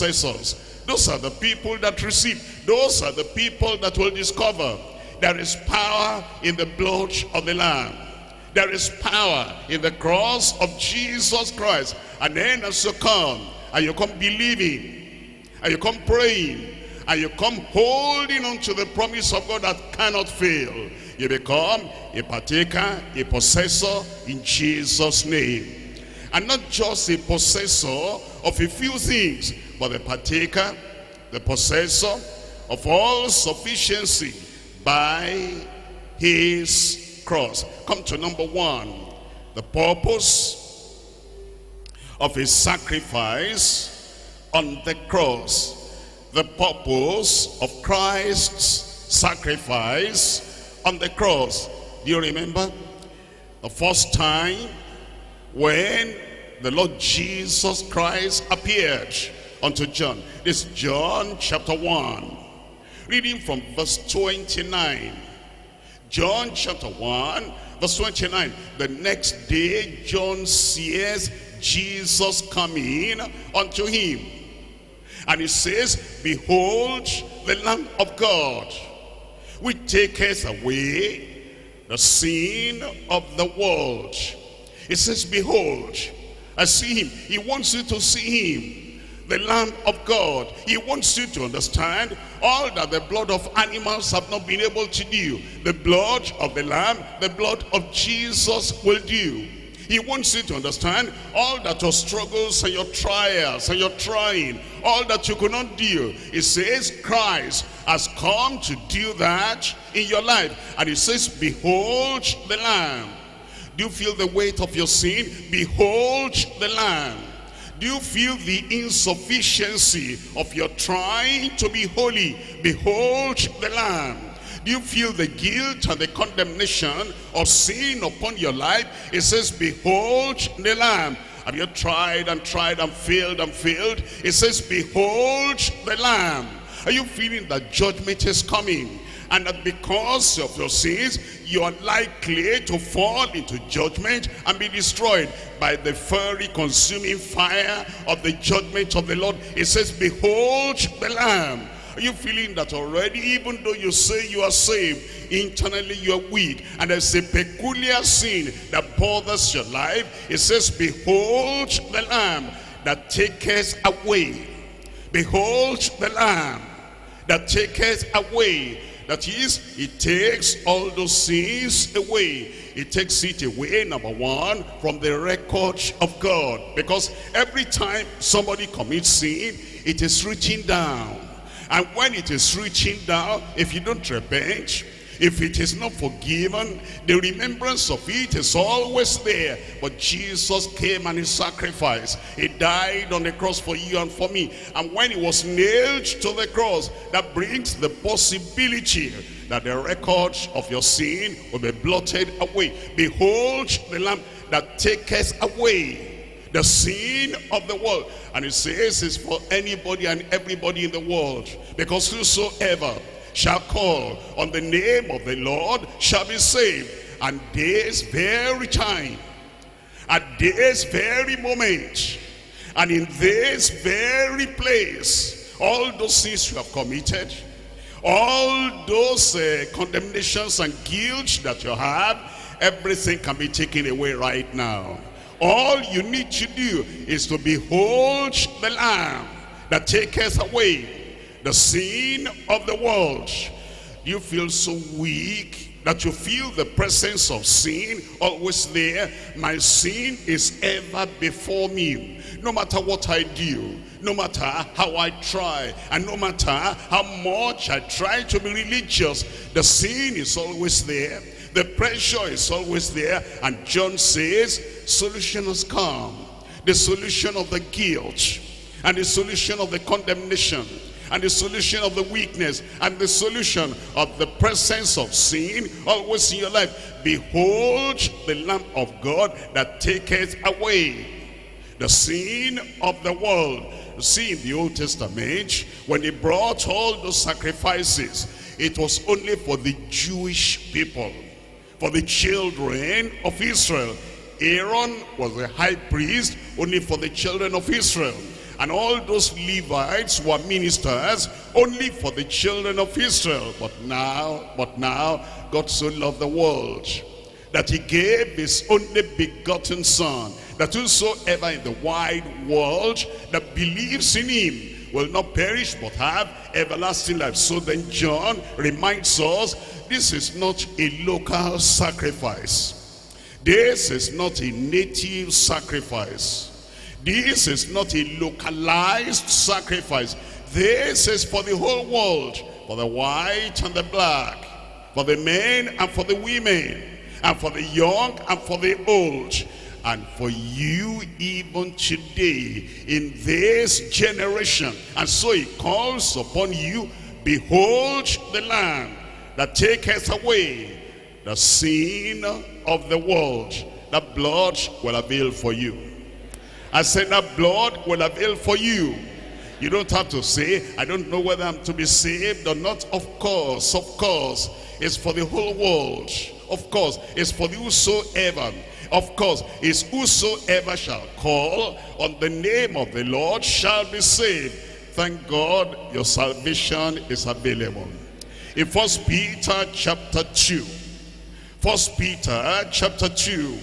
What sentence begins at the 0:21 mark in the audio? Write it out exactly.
You become a partaker, a possessor in Jesus' name.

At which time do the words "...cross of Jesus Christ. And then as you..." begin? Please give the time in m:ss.
0:09.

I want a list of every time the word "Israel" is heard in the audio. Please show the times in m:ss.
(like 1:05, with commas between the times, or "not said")
4:53, 4:57, 5:02.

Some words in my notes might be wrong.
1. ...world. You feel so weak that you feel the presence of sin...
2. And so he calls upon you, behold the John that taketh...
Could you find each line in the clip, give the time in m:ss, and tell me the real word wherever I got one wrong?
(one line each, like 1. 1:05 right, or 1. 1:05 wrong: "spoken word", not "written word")
1. 4:02 right
2. 5:44 wrong: "Lamb", not "John".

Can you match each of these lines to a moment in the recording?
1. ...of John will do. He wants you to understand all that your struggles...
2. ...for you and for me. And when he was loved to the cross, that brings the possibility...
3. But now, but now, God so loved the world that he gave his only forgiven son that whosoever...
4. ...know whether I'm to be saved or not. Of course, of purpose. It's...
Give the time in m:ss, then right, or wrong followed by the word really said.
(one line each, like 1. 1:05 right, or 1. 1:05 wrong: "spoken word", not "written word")
1. 1:37 wrong: "Jesus", not "John"
2. 3:13 wrong: "nailed", not "loved"
3. 5:03 wrong: "begotten", not "forgiven"
4. 6:01 wrong: "course", not "purpose".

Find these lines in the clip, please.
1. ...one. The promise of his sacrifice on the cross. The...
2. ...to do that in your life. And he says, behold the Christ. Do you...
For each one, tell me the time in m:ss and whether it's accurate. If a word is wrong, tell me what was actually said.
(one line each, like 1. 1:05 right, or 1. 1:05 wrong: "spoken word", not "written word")
1. 0:38 wrong: "purpose", not "promise"
2. 1:48 wrong: "Lamb", not "Christ".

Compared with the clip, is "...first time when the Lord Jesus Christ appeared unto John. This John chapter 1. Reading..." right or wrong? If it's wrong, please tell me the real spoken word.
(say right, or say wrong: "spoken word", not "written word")
right.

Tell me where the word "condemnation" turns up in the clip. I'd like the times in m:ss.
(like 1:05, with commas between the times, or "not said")
2:06, 3:49, 4:29.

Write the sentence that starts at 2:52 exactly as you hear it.
It takes it away, number one, from the record of God.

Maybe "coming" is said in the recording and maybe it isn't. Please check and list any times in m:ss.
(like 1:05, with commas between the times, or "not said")
1:12, 2:18.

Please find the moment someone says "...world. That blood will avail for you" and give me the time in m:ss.
5:52.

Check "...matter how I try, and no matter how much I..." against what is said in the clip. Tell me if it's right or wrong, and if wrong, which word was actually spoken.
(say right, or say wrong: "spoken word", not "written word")
right.